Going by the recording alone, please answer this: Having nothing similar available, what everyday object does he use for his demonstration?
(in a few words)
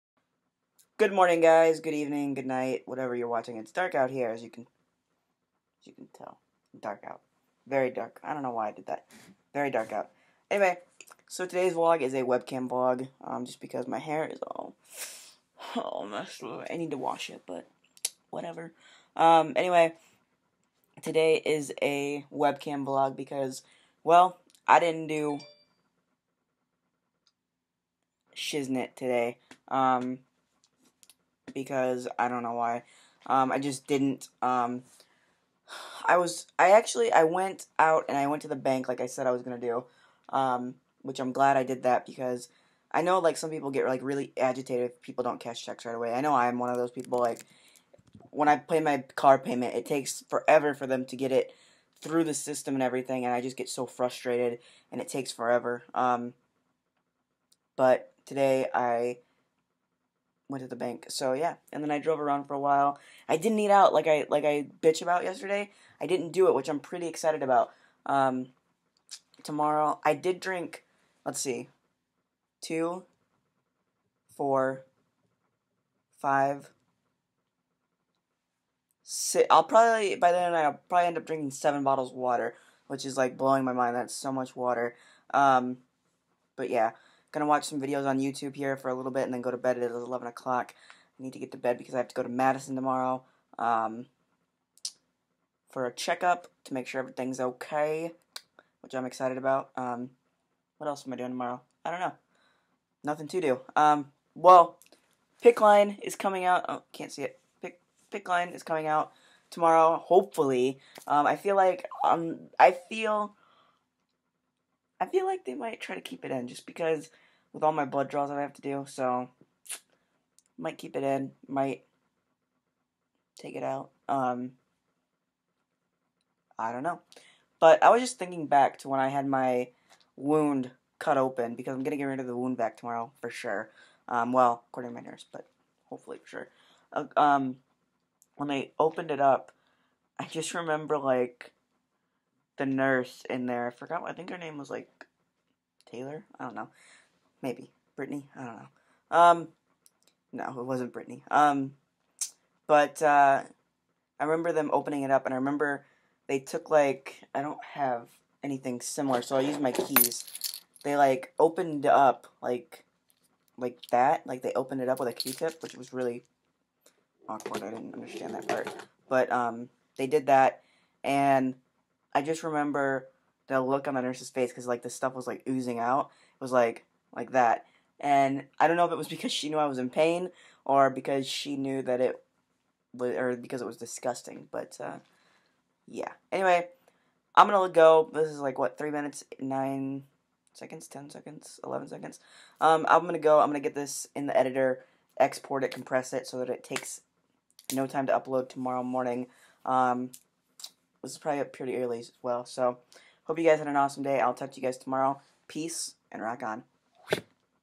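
keys.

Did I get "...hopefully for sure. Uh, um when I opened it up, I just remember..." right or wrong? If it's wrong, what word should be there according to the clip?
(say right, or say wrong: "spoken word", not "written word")
right.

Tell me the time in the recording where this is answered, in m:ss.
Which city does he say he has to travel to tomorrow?
1:32.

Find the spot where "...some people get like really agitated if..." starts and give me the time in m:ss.
0:43.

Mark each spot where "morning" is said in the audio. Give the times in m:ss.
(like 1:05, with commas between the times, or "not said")
0:01, 3:18.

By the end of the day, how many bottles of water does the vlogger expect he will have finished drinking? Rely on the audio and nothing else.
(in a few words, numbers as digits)
7.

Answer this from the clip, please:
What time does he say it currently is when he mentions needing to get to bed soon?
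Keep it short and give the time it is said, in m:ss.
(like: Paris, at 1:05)
11 o'clock, at 1:29.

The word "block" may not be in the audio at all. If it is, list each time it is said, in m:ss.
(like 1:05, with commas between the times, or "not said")
not said.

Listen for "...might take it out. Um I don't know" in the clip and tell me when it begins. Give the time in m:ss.
2:01.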